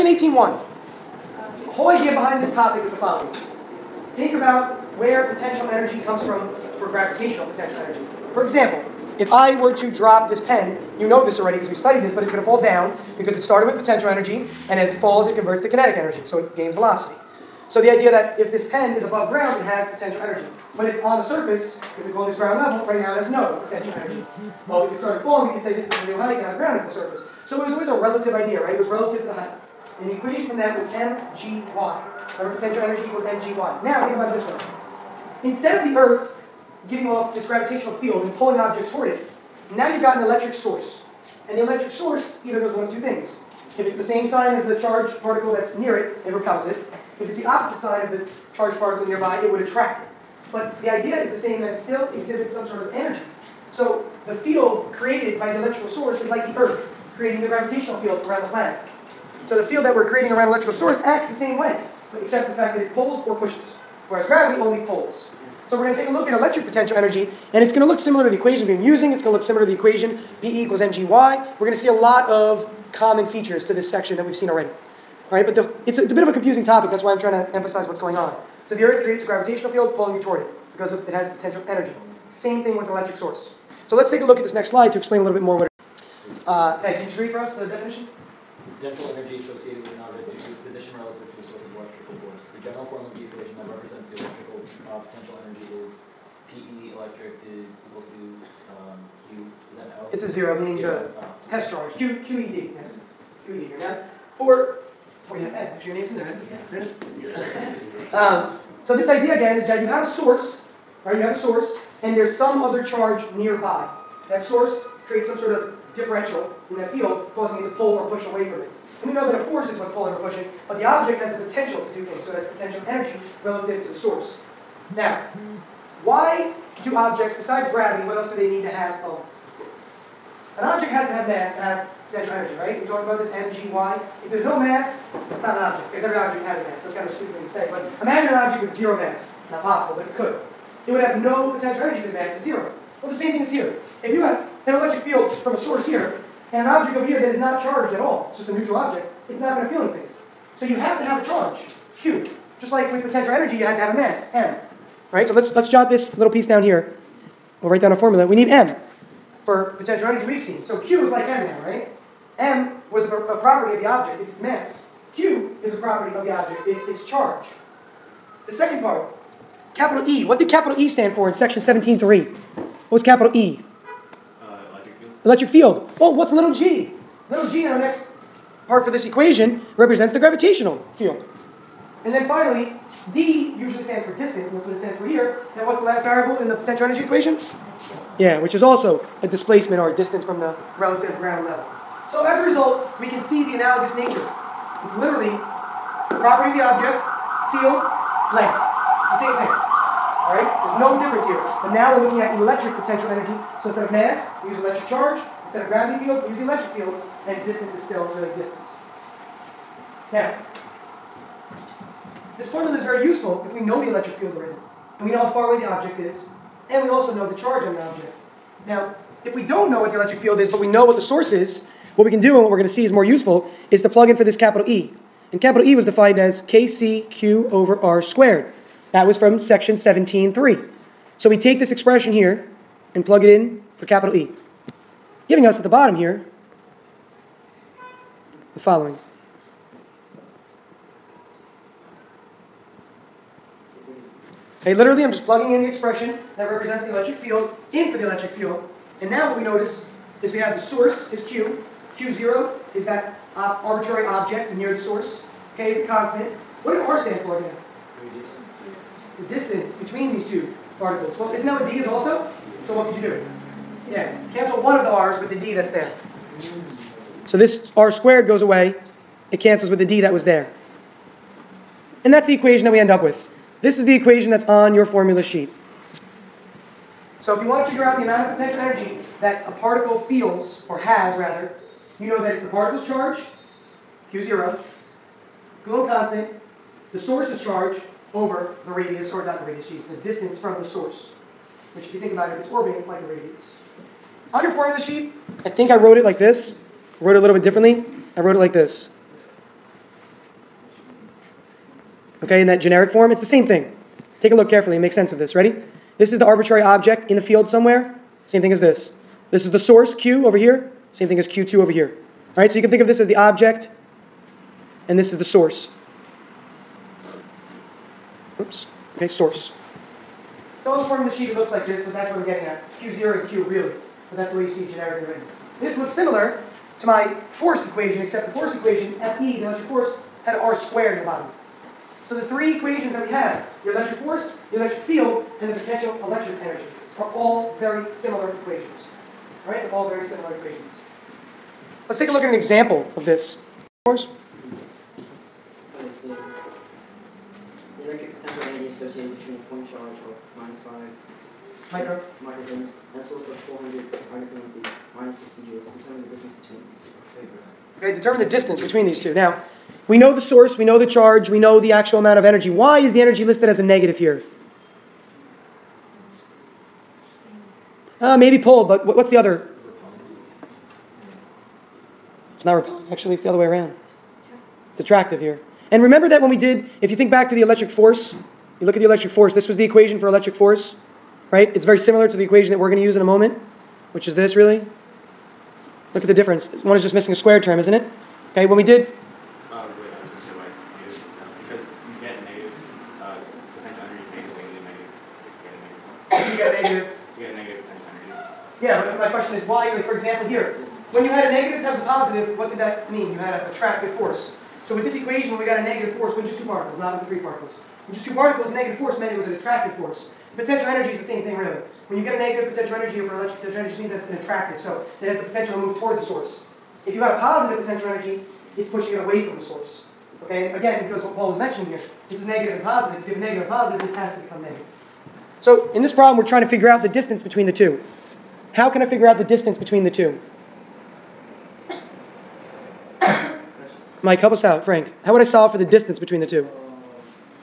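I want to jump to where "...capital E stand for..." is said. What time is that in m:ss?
2:50.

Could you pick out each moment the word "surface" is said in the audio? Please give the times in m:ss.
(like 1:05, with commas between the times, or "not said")
0:21, 0:26.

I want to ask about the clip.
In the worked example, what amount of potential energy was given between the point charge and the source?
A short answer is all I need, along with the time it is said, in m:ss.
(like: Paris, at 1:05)
-60 joules, at 5:54.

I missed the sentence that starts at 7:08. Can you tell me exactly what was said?
How can I figure out the distance between the two?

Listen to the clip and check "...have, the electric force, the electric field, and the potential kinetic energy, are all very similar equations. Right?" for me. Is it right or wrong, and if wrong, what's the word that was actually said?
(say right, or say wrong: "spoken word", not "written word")
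wrong: "electric", not "kinetic".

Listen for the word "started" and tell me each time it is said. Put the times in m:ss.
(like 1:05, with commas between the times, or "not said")
0:13, 0:24.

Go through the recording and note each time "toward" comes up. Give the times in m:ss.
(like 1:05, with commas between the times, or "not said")
0:38, 1:20, 6:55.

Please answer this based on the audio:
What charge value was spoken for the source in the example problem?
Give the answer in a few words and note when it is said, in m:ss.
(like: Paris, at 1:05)
400 micrograms, at 5:53.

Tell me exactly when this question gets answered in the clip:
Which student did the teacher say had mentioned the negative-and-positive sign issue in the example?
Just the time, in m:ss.
7:01.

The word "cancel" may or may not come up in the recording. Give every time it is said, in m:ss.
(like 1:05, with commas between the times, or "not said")
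4:24, 4:29.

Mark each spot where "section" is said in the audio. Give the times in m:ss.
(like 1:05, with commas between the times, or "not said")
1:13, 2:51, 3:49.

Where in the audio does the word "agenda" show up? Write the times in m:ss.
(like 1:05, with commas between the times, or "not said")
not said.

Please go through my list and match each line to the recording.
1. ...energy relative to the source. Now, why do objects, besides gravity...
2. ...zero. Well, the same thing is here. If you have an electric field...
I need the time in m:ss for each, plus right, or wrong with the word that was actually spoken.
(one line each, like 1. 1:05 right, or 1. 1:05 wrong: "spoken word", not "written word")
1. 2:02 right
2. 2:22 right.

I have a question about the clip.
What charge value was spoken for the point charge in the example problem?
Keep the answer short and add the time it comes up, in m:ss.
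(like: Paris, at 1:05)
-5 micrograms, at 5:50.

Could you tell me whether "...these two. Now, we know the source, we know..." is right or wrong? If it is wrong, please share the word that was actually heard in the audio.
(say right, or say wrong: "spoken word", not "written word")
right.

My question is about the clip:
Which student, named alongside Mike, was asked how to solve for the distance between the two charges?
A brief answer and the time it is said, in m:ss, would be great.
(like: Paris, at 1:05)
Frank, at 7:14.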